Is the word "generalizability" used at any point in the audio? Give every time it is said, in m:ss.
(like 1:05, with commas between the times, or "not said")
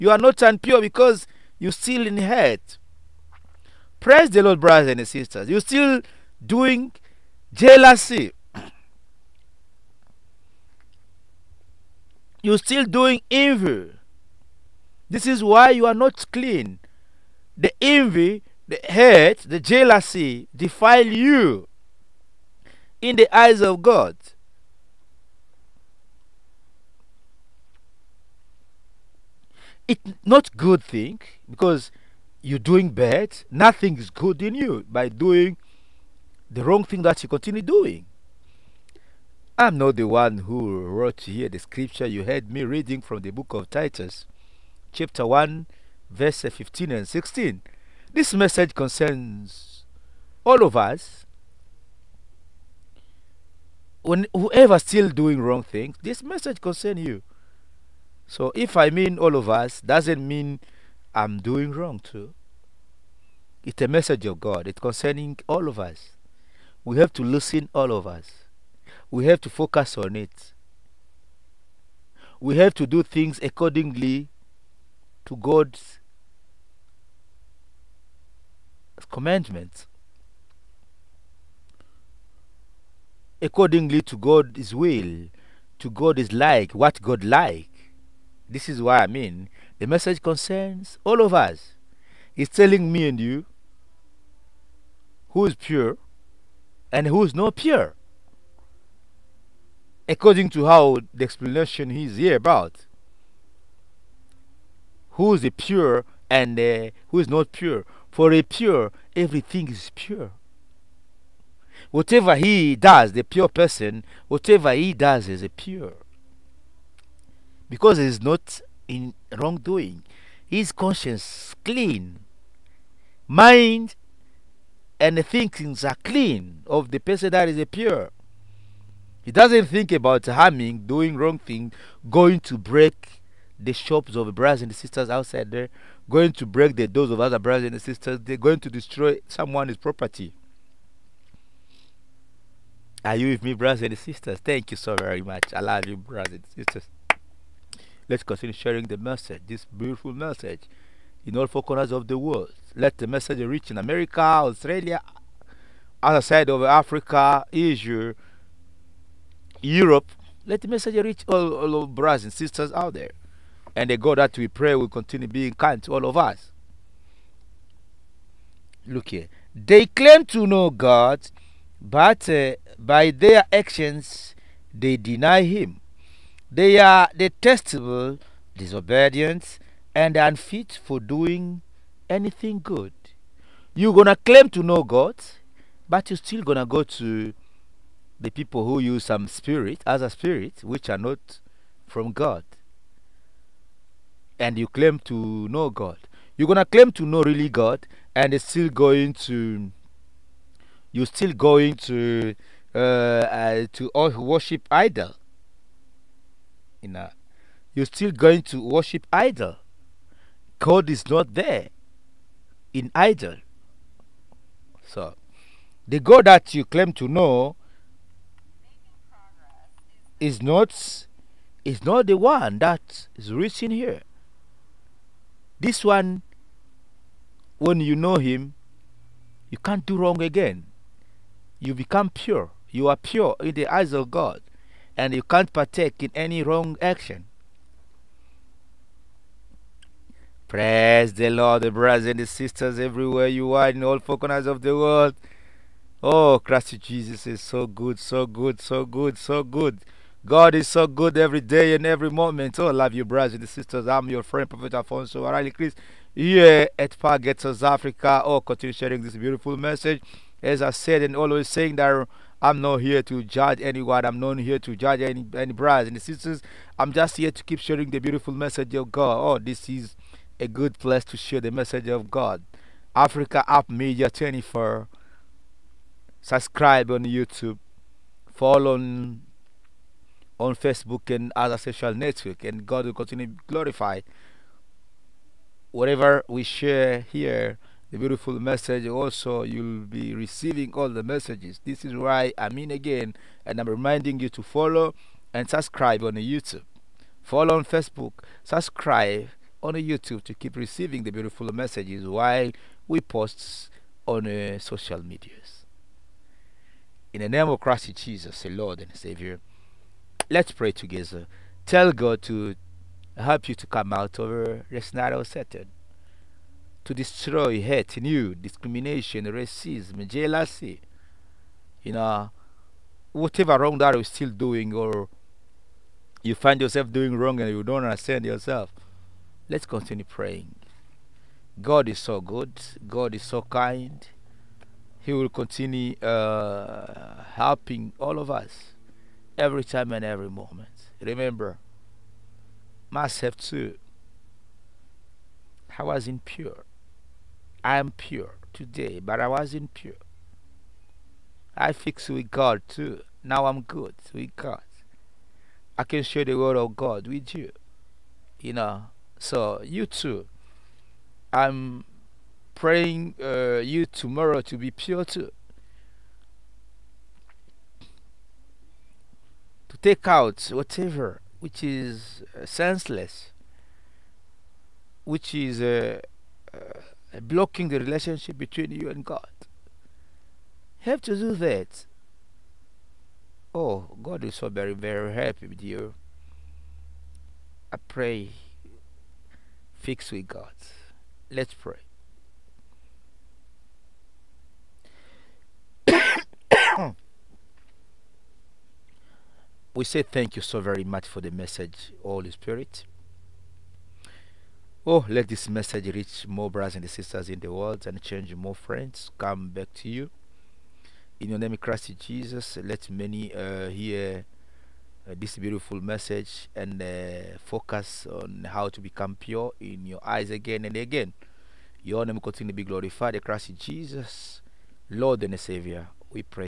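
not said.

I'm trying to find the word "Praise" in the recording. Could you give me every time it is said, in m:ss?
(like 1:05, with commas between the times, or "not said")
0:03, 4:00.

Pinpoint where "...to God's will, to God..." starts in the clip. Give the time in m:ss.
1:24.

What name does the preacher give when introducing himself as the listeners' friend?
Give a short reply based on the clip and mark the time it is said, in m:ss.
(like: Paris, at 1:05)
Prophet Alfonso Warally Chris, at 4:14.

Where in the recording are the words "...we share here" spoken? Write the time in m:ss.
4:46.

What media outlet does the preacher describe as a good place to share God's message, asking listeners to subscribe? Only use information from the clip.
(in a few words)
Africa Up Media 24.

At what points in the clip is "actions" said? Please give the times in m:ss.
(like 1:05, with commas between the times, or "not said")
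2:53, 3:56.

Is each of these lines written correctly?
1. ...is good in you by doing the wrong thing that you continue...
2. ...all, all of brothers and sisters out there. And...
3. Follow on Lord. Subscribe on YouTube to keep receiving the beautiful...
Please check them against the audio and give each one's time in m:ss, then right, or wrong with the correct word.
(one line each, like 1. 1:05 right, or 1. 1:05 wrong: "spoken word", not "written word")
1. 0:33 right
2. 2:41 right
3. 4:57 wrong: "Facebook", not "Lord".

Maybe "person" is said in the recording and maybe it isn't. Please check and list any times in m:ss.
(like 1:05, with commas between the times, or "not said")
1:53, 2:06.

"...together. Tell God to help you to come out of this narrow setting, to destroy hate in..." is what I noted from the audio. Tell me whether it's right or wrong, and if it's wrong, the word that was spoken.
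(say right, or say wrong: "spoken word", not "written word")
right.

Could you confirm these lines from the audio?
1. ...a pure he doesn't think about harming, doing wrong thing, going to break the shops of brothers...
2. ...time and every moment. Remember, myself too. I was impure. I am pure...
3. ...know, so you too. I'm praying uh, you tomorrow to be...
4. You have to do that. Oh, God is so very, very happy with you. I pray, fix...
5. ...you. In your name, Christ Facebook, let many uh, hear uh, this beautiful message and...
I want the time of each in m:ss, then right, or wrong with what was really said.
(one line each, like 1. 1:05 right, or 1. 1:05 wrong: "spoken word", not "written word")
1. 2:07 right
2. 5:39 right
3. 5:58 right
4. 6:20 right
5. 6:49 wrong: "Jesus", not "Facebook".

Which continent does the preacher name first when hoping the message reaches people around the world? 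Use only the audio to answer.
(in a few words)
America.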